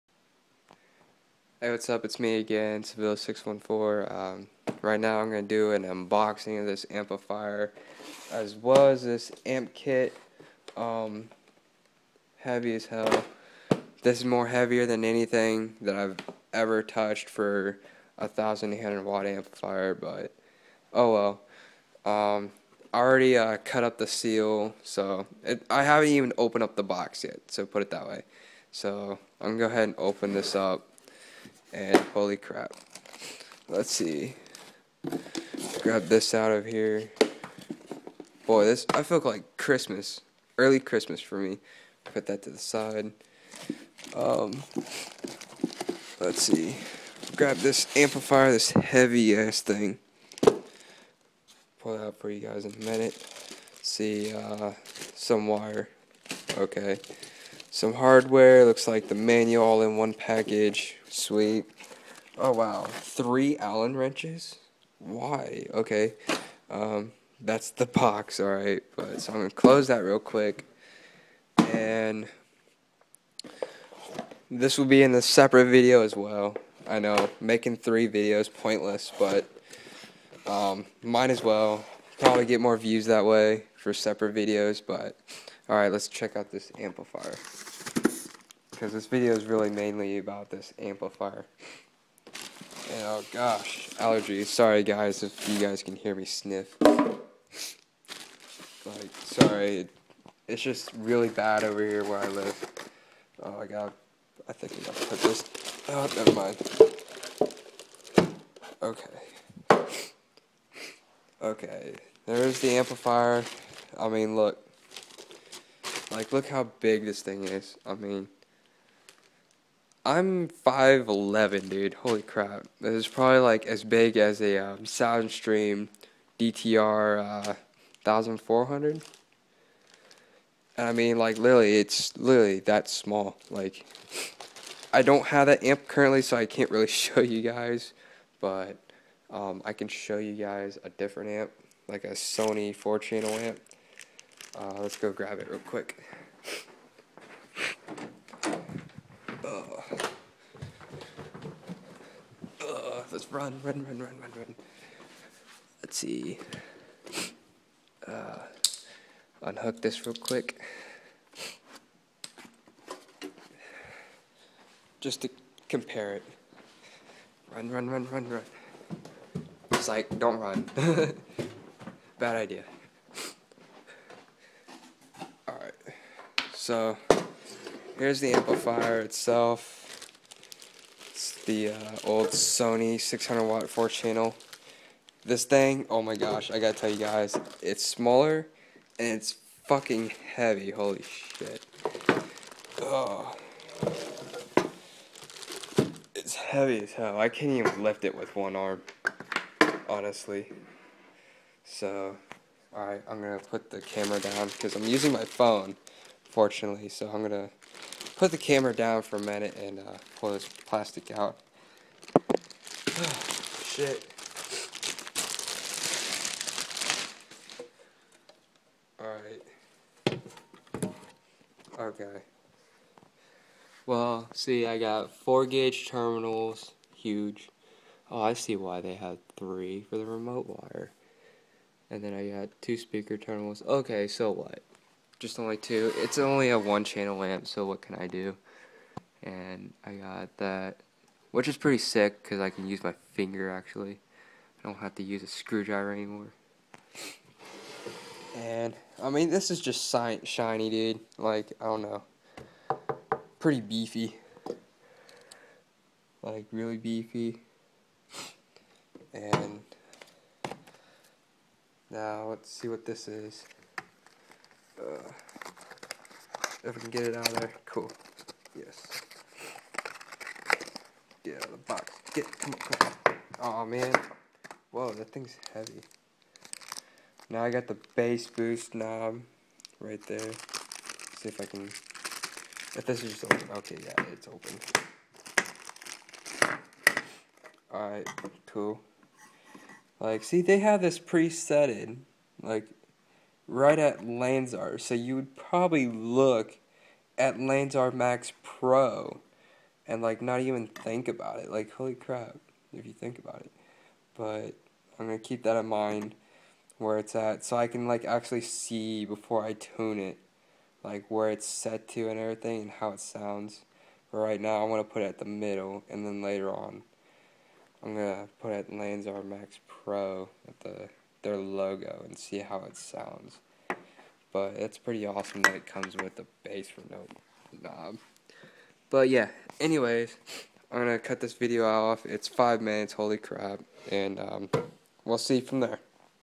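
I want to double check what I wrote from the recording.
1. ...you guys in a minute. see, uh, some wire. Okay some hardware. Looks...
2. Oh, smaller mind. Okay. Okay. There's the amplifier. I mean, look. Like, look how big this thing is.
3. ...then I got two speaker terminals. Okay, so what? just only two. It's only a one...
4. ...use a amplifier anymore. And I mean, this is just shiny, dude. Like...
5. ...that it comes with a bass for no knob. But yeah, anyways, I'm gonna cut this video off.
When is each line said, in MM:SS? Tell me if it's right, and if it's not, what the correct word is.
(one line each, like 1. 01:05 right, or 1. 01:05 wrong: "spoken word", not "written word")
1. 00:52 right
2. 01:45 wrong: "never", not "smaller"
3. 03:52 right
4. 04:05 wrong: "screwdriver", not "amplifier"
5. 05:25 right.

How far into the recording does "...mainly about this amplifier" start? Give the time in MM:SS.
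01:29.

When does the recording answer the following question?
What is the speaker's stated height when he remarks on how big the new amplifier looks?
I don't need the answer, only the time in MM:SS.
02:00.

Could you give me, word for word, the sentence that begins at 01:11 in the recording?
And this will be in a separate video as well.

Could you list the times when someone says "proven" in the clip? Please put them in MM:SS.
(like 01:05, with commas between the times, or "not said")
not said.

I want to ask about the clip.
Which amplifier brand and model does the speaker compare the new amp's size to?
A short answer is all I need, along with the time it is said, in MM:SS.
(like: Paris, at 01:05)
Soundstream DTR 1400, at 02:04.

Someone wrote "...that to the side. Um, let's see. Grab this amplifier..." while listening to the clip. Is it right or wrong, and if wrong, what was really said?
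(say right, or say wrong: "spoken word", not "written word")
right.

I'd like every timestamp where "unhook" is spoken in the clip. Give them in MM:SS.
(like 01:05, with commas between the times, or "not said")
02:39.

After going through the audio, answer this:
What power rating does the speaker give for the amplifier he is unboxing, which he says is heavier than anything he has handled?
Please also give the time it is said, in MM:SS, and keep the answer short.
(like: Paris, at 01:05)
1800 watt, at 00:18.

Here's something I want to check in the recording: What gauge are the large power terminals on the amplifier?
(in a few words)
4 gauge.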